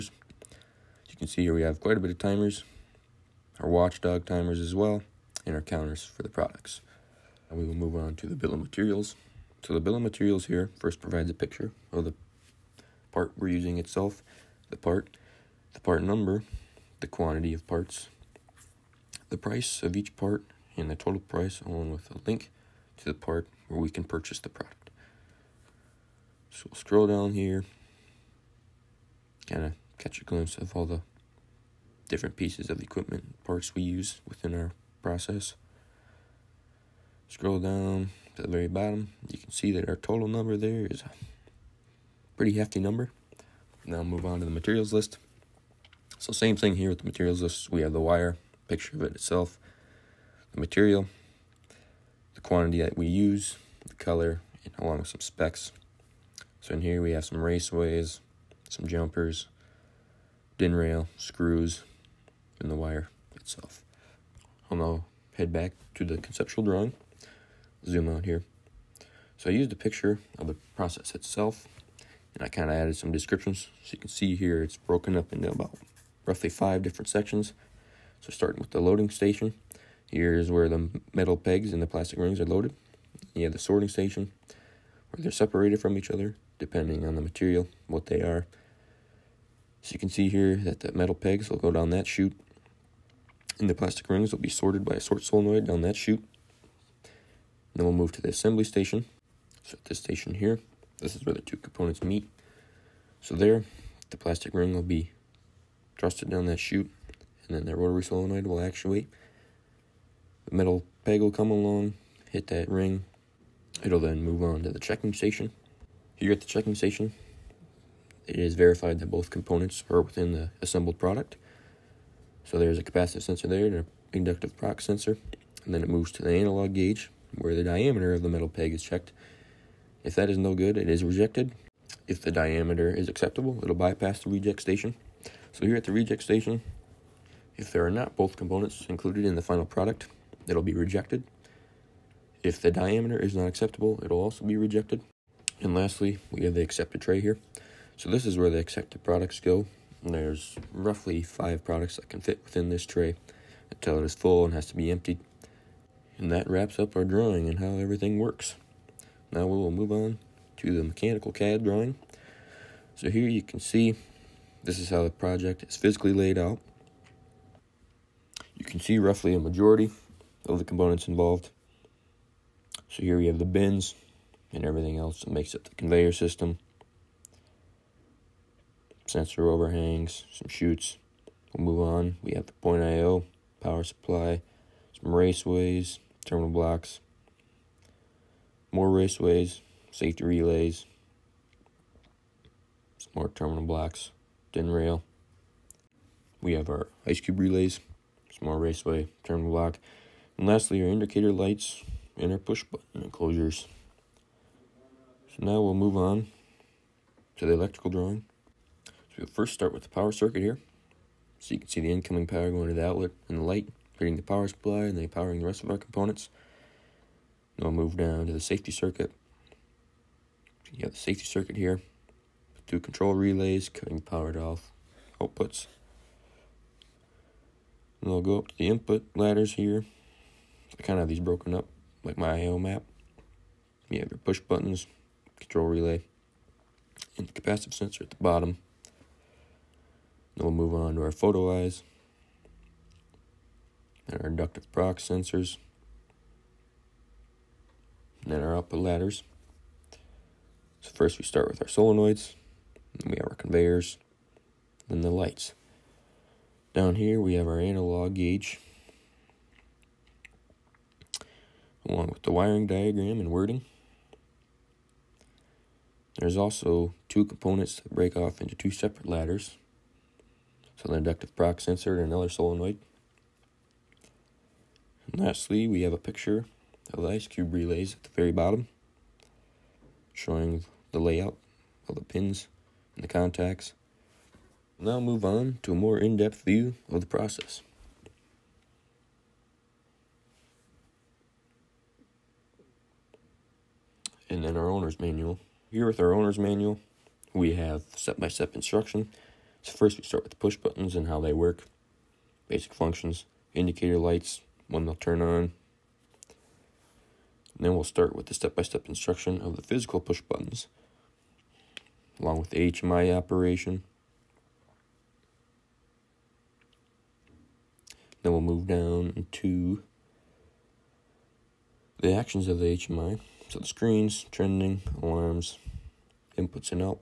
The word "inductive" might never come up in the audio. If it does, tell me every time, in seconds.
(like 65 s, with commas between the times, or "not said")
124 s, 244 s, 270 s.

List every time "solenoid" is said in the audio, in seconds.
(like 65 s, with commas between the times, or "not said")
95 s, 108 s, 251 s, 272 s.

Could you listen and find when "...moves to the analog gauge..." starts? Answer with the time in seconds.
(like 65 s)
125 s.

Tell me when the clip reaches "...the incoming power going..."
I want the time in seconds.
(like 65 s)
211 s.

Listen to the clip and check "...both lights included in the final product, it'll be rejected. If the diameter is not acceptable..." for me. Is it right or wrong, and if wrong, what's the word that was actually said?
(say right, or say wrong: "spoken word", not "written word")
wrong: "components", not "lights".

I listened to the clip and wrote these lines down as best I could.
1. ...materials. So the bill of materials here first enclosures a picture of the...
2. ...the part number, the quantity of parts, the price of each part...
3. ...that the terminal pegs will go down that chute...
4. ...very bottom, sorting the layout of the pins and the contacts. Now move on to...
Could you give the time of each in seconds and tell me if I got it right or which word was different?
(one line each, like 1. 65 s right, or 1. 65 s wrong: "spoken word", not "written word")
1. 8 s wrong: "provides", not "enclosures"
2. 15 s right
3. 90 s wrong: "metal", not "terminal"
4. 278 s wrong: "showing", not "sorting".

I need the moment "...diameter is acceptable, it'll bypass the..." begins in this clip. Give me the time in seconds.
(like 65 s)
132 s.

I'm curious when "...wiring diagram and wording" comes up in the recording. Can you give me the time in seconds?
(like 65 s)
262 s.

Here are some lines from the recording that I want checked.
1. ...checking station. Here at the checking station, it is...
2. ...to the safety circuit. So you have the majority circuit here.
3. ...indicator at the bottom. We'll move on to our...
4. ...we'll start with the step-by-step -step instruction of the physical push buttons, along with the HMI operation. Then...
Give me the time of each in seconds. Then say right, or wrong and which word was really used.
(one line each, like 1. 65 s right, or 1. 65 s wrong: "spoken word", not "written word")
1. 114 s right
2. 218 s wrong: "safety", not "majority"
3. 237 s wrong: "sensor", not "indicator"
4. 307 s right.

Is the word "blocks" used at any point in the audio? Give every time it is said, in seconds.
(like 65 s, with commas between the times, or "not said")
186 s, 193 s, 199 s.